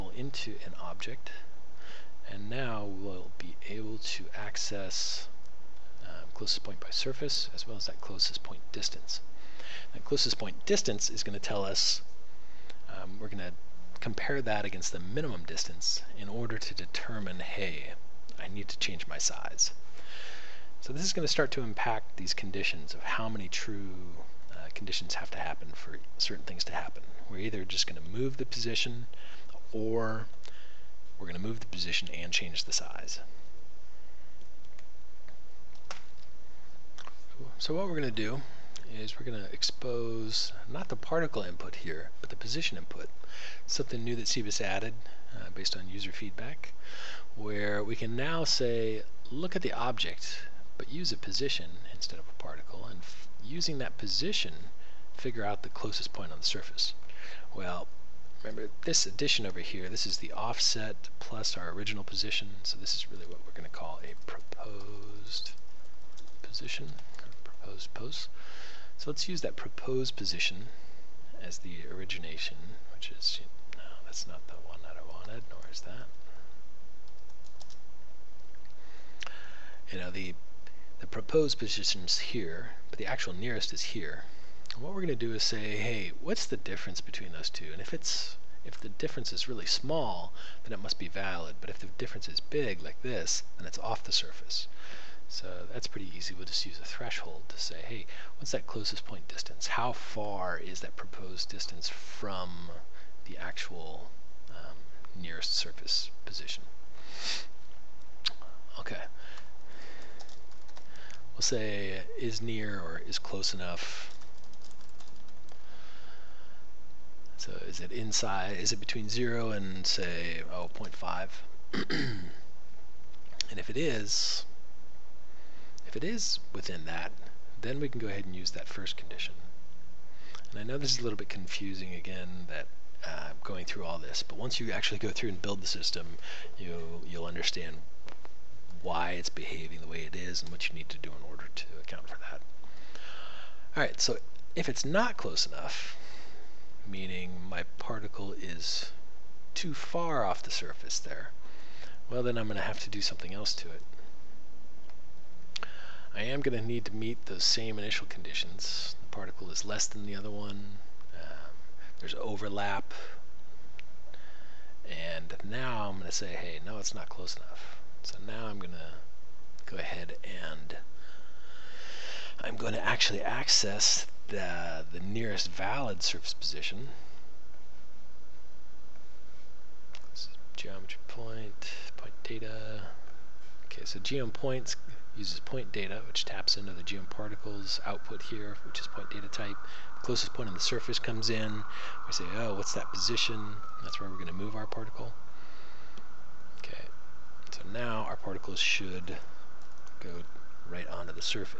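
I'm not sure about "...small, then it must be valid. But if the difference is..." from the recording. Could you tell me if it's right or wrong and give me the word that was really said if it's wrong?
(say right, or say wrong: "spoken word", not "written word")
right.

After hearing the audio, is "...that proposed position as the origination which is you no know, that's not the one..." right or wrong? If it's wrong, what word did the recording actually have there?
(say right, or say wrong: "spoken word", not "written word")
right.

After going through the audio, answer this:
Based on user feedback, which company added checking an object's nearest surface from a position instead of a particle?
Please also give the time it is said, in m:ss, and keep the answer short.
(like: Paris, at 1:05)
Cebas, at 0:44.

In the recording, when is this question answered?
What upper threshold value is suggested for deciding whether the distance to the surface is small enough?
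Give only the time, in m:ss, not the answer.
2:00.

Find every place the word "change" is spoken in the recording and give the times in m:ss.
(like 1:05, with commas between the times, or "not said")
0:18, 0:32.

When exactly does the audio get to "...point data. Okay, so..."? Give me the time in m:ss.
3:01.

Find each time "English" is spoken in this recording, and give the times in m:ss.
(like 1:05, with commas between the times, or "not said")
not said.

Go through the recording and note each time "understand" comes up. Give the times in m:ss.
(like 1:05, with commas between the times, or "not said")
2:17.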